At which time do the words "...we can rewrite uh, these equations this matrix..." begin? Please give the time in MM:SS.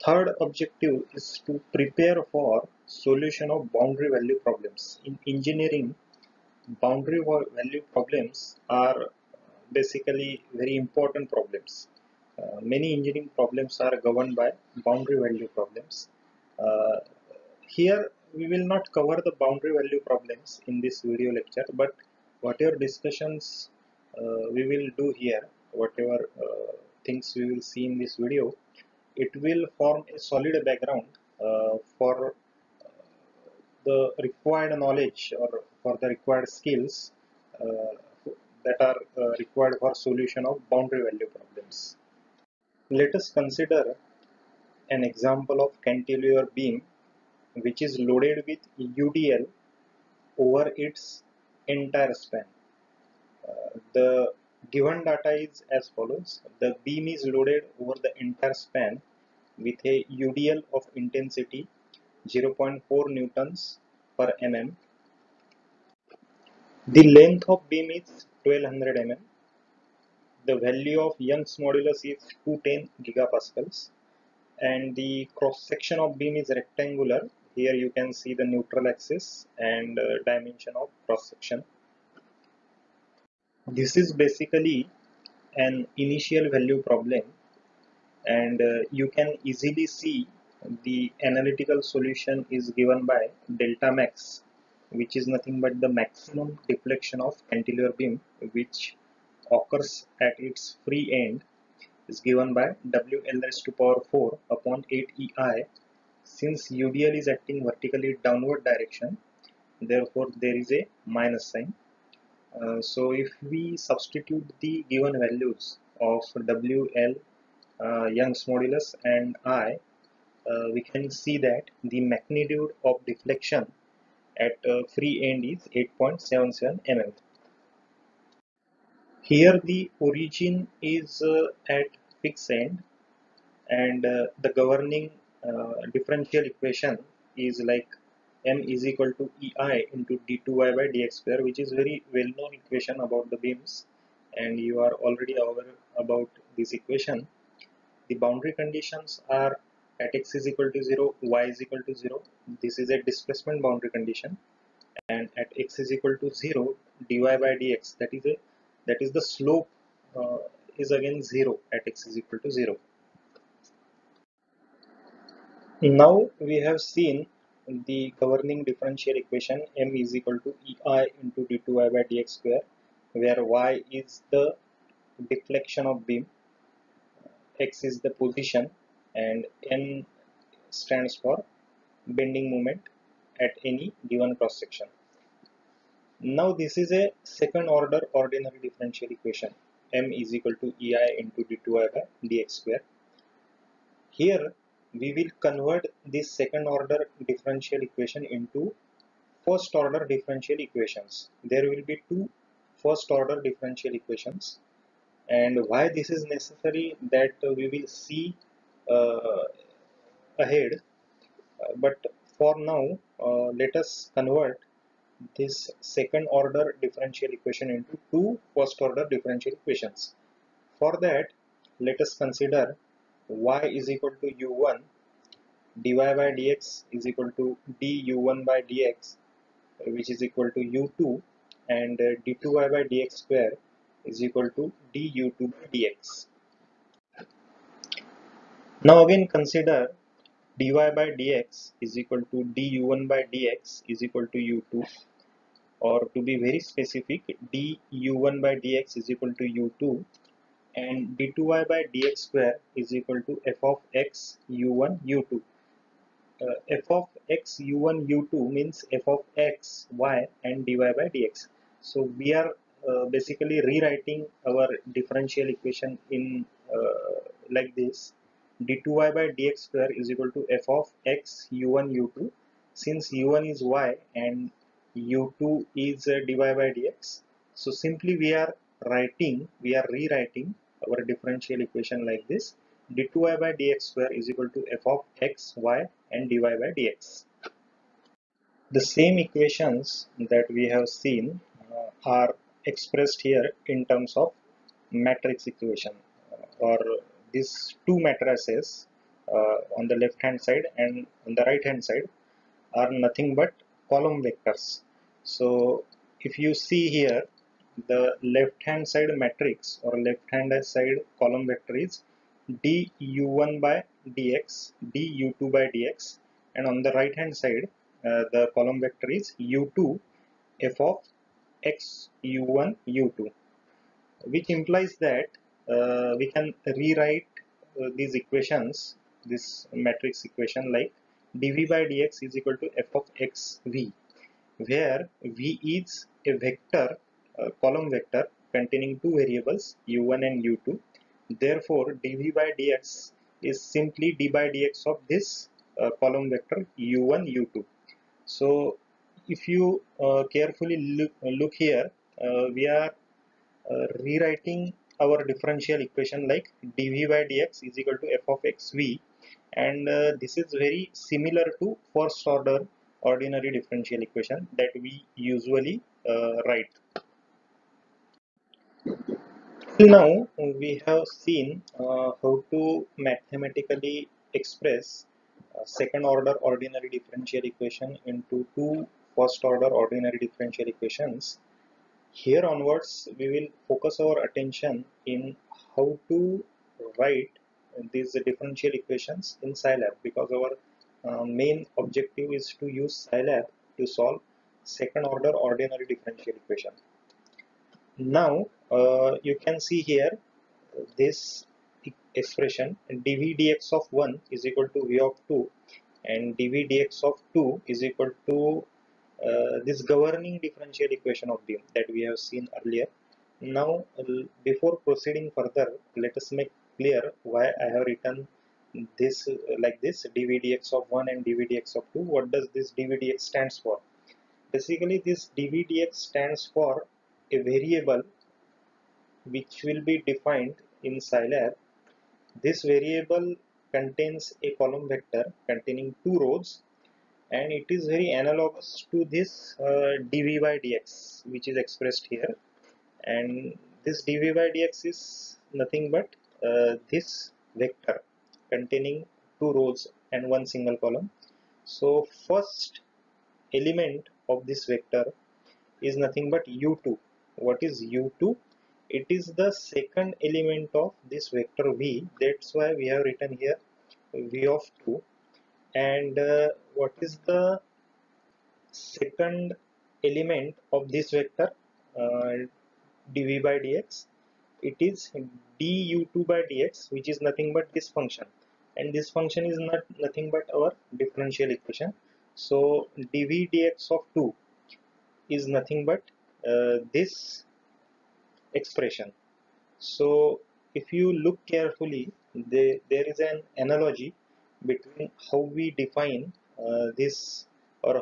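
05:26.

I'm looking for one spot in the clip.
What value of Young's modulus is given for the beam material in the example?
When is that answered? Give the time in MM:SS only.
01:12.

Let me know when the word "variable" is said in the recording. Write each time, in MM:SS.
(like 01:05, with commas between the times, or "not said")
05:39, 07:07, 07:12.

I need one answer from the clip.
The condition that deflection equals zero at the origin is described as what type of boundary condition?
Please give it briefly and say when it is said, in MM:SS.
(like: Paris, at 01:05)
Displacement boundary condition, at 02:33.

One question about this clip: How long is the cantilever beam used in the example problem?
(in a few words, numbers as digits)
1200 mm.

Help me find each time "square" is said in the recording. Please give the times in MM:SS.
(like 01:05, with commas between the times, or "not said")
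02:21, 02:52, 03:12, 03:53, 04:12, 04:29, 04:43.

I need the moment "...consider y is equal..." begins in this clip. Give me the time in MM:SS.
03:42.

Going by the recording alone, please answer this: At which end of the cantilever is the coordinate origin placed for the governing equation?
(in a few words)
Fixed end.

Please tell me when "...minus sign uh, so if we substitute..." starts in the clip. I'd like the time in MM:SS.
01:51.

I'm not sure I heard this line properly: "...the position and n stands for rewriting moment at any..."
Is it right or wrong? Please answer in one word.
wrong.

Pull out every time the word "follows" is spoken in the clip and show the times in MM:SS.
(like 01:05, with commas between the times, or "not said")
00:55.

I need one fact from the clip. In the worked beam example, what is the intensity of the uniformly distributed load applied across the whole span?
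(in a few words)
0.4 N/mm.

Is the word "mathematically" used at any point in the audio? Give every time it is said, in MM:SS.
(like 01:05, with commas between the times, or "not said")
06:13.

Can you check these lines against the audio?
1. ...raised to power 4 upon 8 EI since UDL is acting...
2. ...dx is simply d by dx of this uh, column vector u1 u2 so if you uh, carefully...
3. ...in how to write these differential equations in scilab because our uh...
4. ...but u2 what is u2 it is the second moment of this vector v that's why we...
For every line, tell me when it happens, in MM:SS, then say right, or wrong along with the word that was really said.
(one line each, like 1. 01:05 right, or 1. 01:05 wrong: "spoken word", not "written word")
1. 01:43 right
2. 05:42 right
3. 06:25 right
4. 07:36 wrong: "element", not "moment".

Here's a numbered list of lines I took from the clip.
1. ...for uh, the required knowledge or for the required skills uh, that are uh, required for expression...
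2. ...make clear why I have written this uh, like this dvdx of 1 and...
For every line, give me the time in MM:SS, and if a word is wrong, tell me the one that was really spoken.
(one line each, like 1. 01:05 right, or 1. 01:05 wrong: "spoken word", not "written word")
1. 00:31 wrong: "solution", not "expression"
2. 06:56 right.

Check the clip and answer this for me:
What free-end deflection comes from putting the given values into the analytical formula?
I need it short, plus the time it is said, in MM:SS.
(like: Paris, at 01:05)
8.77 mm, at 02:05.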